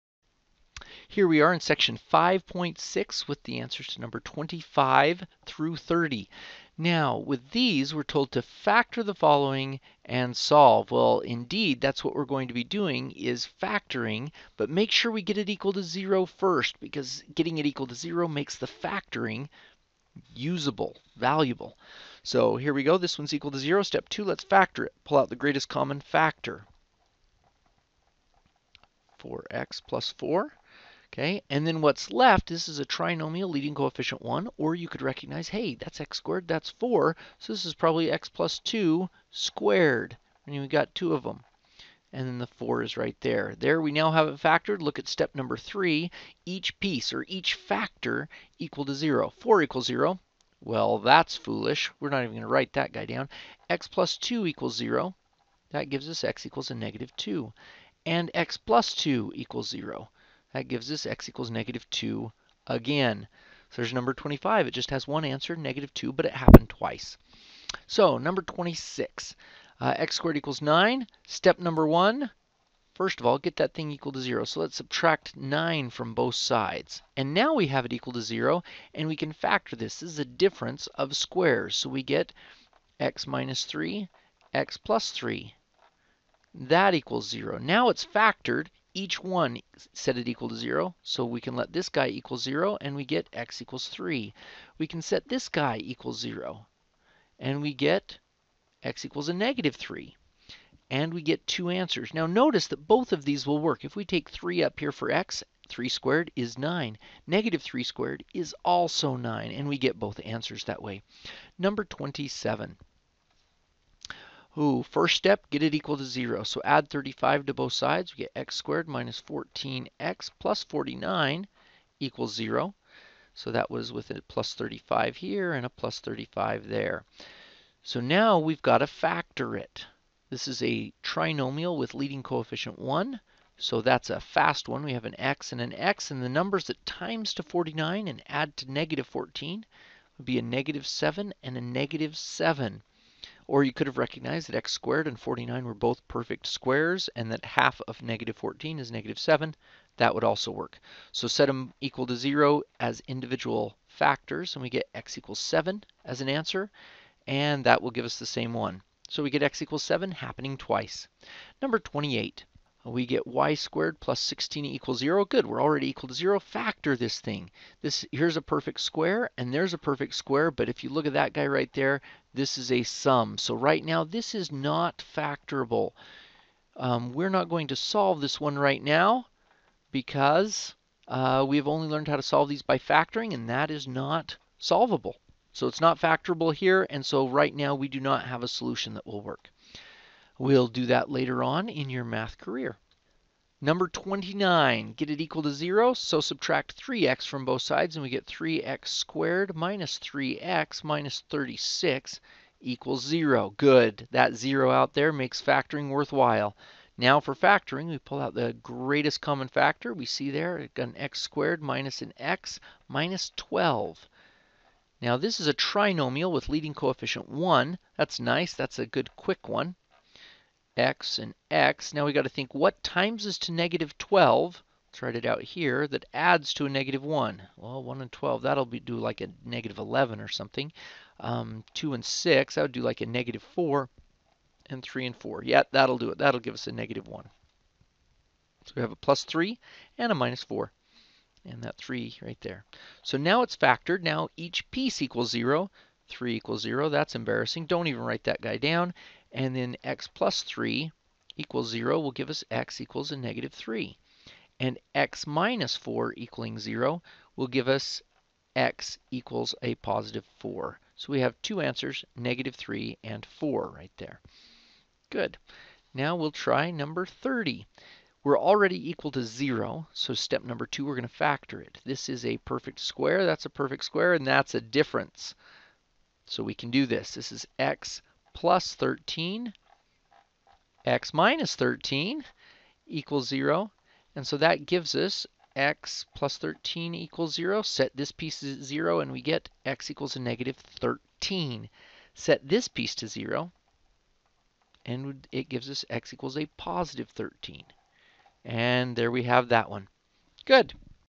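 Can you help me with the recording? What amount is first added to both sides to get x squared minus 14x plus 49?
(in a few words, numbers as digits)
35.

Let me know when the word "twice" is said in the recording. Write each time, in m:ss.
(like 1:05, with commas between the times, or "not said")
1:06, 2:40.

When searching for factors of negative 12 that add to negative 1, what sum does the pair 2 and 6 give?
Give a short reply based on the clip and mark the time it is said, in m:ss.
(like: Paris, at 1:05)
-4, at 3:53.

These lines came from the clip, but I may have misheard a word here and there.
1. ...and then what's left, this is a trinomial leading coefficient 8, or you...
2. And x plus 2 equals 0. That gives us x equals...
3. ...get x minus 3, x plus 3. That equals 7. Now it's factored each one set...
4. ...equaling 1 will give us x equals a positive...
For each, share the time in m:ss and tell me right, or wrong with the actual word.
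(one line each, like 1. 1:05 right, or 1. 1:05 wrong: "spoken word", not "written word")
1. 0:31 wrong: "1", not "8"
2. 0:58 right
3. 1:22 wrong: "0", not "7"
4. 4:16 wrong: "0", not "1".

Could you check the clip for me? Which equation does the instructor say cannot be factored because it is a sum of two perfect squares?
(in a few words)
y squared plus 16 equals 0.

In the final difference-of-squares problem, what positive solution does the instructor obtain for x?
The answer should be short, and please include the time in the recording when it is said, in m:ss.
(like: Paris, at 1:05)
13, at 4:55.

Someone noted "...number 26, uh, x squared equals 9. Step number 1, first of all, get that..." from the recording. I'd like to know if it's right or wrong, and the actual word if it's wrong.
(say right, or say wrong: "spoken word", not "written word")
right.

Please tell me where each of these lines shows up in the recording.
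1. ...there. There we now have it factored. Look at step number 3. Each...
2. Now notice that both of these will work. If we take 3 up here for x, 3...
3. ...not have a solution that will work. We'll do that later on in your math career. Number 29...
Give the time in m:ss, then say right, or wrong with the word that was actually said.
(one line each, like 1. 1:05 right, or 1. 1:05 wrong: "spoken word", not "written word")
1. 0:43 right
2. 1:42 right
3. 3:07 right.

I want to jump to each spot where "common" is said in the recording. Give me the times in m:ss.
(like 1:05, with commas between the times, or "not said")
0:25, 3:29.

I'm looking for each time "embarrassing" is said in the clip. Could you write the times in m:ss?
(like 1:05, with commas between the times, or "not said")
4:07.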